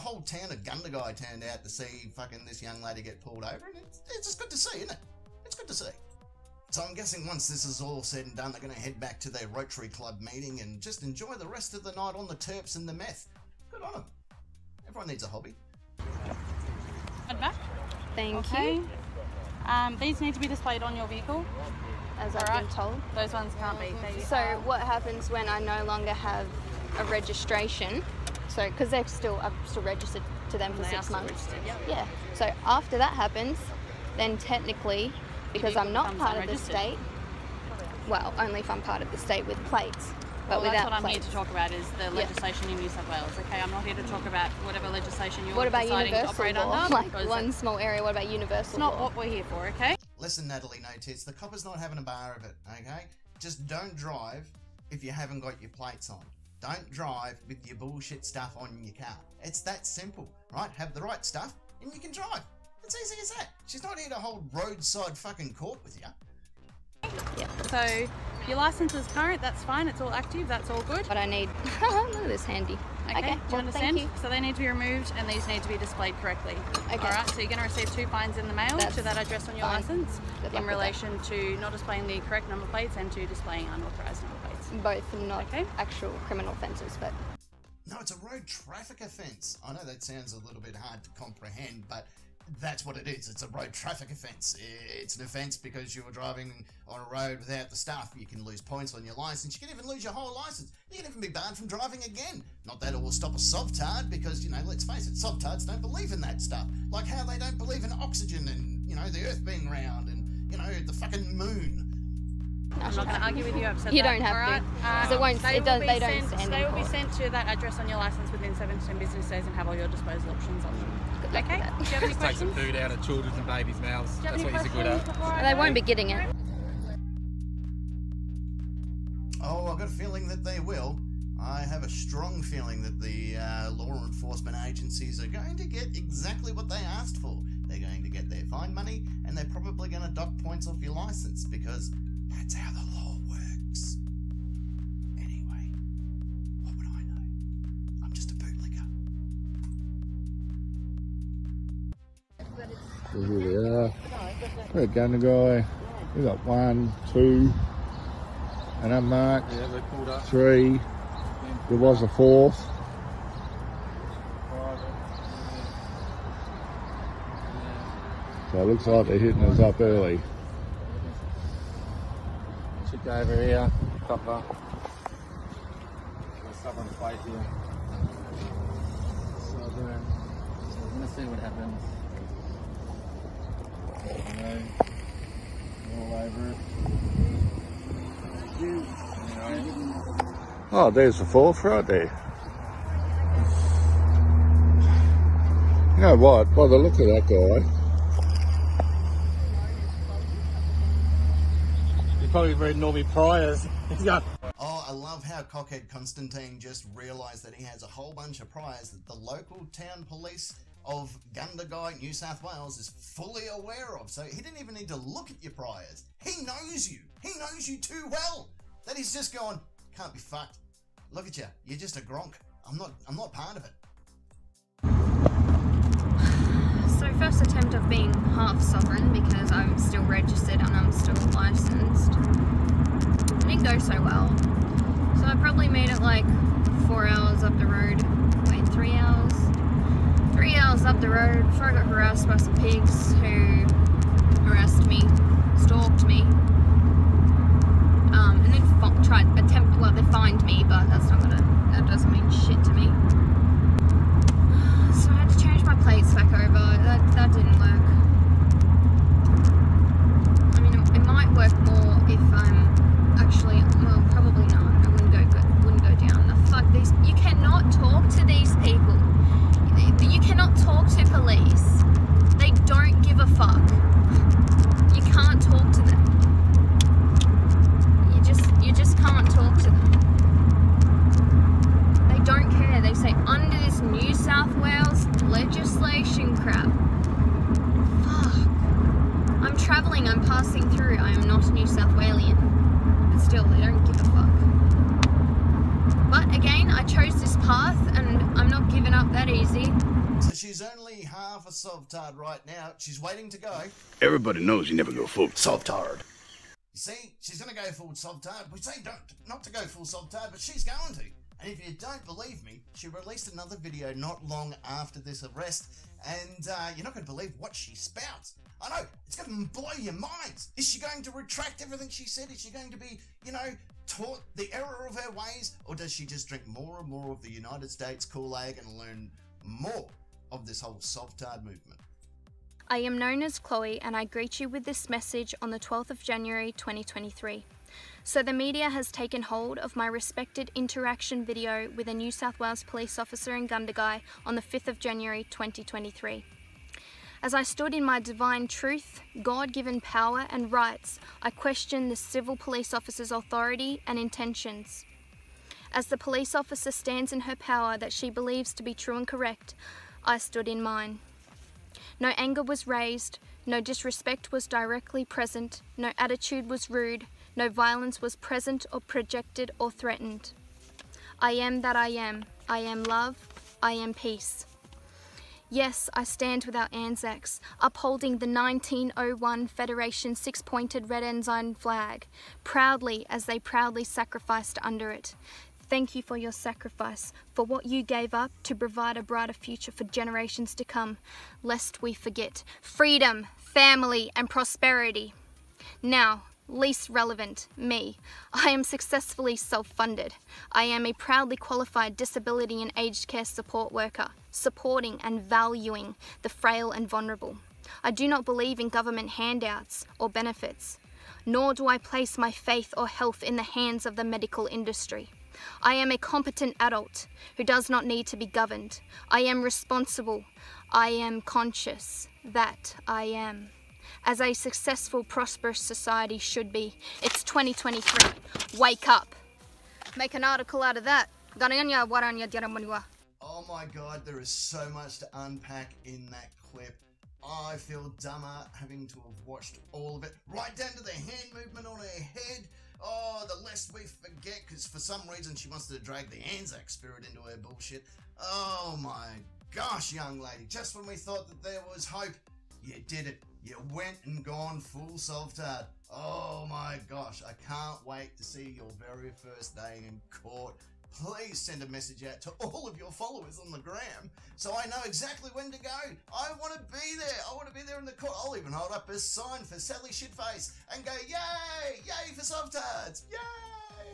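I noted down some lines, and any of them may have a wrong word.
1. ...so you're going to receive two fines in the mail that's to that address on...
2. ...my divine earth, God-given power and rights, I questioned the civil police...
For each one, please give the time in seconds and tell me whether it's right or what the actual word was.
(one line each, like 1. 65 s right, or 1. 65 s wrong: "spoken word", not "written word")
1. 77 s right
2. 347 s wrong: "truth", not "earth".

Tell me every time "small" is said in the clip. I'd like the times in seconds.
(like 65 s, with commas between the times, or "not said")
47 s.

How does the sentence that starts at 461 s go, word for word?
Please send a message out to all of your followers on the gram so I know exactly when to go.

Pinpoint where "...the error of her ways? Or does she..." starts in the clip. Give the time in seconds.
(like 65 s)
324 s.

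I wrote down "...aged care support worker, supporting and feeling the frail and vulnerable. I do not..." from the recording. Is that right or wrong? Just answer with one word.
wrong.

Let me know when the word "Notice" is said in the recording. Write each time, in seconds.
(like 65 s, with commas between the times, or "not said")
50 s.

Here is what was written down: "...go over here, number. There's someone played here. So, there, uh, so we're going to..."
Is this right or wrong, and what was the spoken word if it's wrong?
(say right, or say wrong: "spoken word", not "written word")
wrong: "copper", not "number".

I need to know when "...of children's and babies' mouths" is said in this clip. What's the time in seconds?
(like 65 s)
122 s.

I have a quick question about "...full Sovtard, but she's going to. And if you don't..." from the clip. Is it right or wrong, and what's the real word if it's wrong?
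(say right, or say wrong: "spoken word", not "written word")
right.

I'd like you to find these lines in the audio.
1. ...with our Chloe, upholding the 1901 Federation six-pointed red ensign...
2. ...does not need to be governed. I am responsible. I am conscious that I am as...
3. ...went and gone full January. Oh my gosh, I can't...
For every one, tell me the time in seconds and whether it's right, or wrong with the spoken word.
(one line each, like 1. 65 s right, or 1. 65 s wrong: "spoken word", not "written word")
1. 376 s wrong: "Anzacs", not "Chloe"
2. 417 s right
3. 453 s wrong: "Sovtard", not "January".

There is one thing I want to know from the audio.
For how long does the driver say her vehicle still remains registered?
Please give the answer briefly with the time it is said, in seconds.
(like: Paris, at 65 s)
6 months, at 30 s.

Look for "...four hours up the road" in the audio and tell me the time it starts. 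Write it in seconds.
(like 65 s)
236 s.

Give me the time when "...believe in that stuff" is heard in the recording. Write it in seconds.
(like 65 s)
105 s.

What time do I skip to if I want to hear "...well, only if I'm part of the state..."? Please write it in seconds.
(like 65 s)
38 s.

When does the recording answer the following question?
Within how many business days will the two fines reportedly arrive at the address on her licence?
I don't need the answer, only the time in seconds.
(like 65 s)
118 s.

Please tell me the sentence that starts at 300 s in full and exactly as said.
So she's only half a Sovtard right now.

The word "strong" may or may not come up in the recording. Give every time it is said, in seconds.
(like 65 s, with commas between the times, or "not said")
131 s.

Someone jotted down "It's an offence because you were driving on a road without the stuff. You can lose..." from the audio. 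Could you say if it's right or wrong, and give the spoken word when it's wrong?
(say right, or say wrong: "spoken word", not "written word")
right.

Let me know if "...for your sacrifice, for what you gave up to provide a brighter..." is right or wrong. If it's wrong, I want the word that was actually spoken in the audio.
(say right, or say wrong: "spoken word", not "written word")
right.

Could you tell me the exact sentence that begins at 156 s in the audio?
We got one, two, an unmarked, yeah, three.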